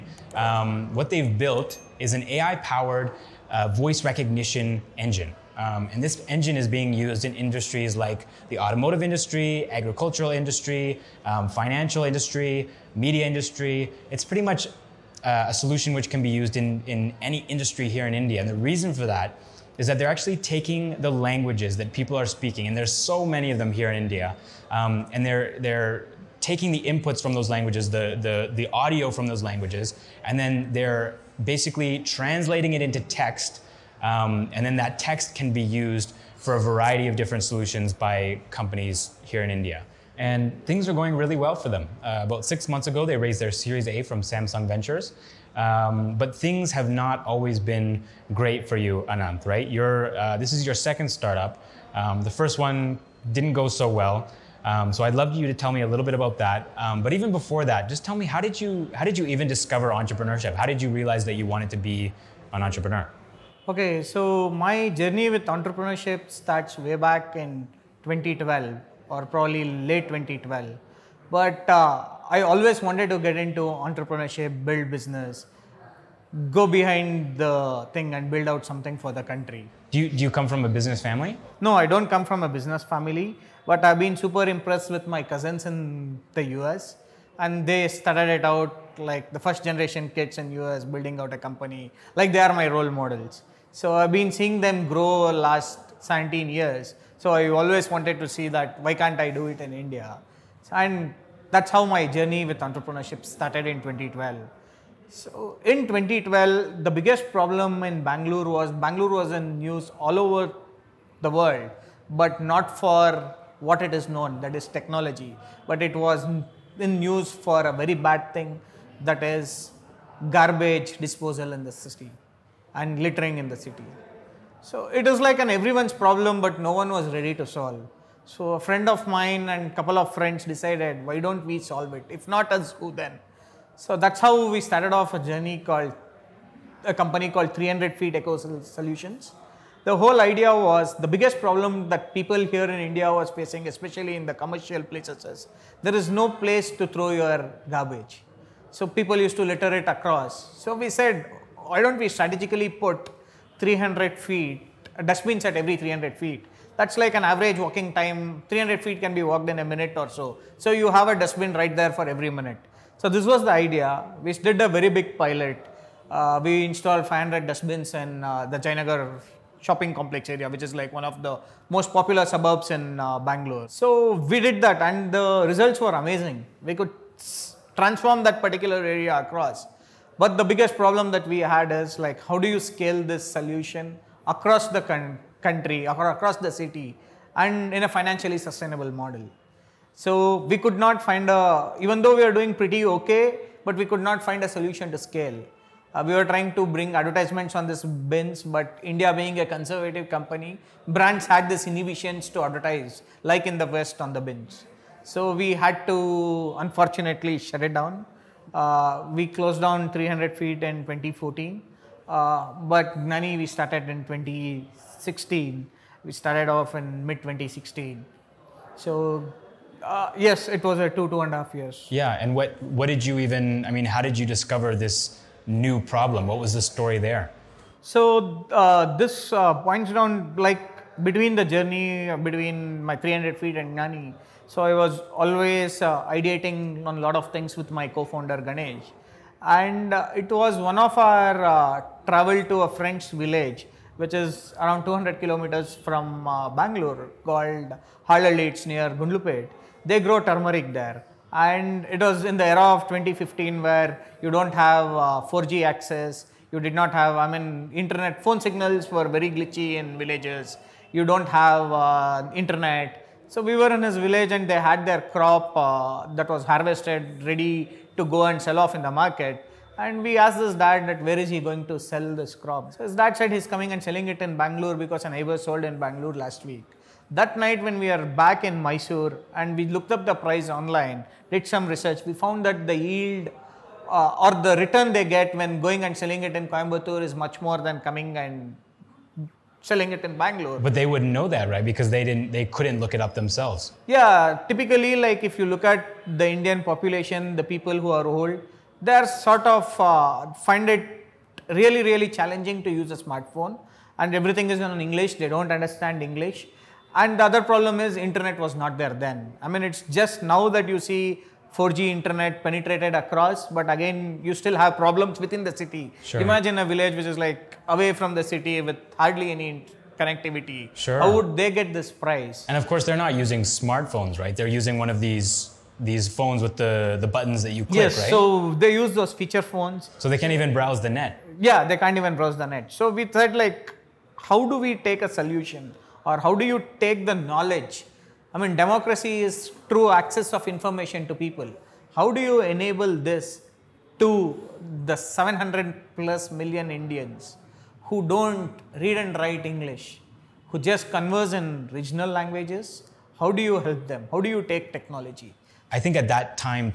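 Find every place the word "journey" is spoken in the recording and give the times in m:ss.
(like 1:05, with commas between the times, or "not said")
1:04, 1:42, 2:15, 3:51.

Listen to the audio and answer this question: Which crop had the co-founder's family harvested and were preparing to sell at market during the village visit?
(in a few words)
Turmeric.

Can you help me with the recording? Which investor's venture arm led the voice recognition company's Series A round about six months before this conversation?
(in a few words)
Samsung Ventures.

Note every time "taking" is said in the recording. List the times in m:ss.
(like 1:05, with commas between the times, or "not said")
0:20, 0:26.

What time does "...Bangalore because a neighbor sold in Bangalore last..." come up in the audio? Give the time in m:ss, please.
4:34.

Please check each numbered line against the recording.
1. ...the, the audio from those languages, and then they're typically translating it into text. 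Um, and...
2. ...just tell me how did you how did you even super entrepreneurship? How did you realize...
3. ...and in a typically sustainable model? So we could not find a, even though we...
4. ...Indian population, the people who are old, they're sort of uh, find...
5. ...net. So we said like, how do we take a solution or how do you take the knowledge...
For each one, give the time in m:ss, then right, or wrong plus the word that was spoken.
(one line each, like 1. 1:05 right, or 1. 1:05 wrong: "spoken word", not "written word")
1. 0:28 wrong: "basically", not "typically"
2. 0:57 wrong: "discover", not "super"
3. 3:07 wrong: "financially", not "typically"
4. 4:56 right
5. 5:32 right.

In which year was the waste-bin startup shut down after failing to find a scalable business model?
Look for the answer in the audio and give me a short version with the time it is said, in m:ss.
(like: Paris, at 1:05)
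2014, at 3:30.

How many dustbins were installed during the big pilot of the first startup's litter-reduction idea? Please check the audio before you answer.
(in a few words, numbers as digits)
500.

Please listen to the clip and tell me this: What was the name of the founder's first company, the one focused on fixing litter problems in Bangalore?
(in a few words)
300 Feet Eco Solutions.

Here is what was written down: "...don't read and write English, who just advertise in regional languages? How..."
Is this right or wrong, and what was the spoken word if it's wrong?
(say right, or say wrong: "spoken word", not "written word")
wrong: "converse", not "advertise".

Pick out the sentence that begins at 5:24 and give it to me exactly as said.
They're using one of these these phones with the, the buttons that you click, yes, right?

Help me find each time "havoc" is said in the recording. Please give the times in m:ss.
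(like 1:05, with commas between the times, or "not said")
not said.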